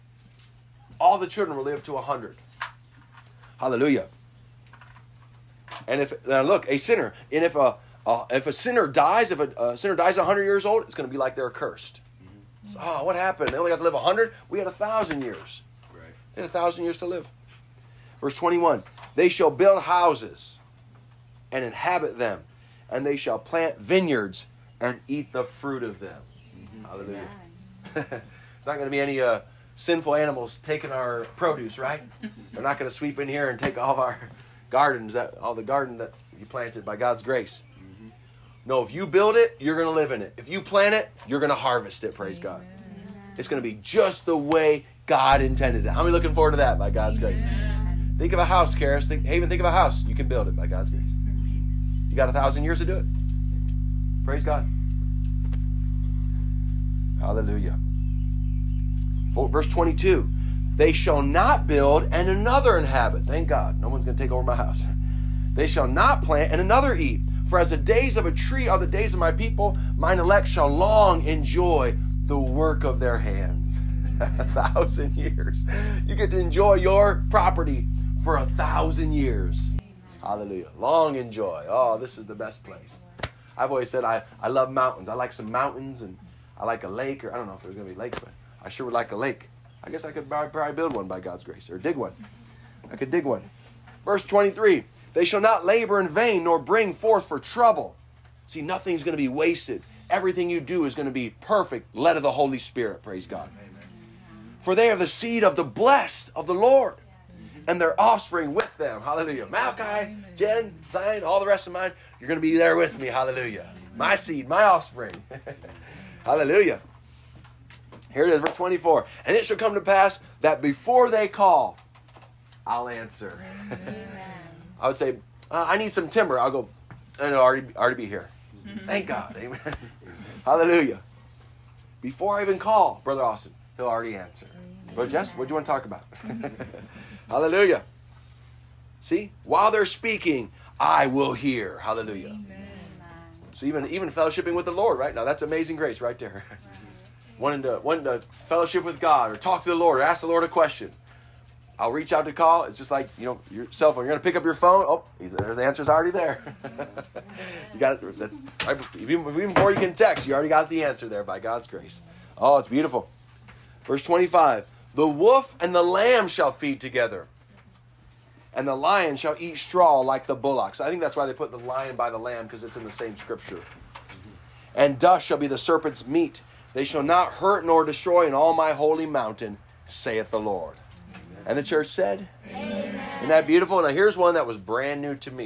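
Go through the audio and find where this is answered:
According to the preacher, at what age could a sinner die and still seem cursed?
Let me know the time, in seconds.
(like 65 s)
10 s.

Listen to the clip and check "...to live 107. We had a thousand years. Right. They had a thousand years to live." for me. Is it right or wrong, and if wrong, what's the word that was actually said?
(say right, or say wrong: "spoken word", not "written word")
wrong: "100", not "107".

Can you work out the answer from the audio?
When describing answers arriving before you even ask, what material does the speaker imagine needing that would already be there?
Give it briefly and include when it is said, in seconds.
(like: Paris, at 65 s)
timber, at 126 s.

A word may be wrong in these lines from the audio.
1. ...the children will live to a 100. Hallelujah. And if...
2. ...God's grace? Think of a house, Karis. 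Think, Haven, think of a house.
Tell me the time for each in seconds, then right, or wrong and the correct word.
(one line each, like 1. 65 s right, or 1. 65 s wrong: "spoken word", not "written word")
1. 1 s right
2. 46 s right.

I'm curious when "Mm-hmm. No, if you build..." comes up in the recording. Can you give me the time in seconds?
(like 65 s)
37 s.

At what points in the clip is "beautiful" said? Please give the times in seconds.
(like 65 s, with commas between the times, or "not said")
162 s, 183 s.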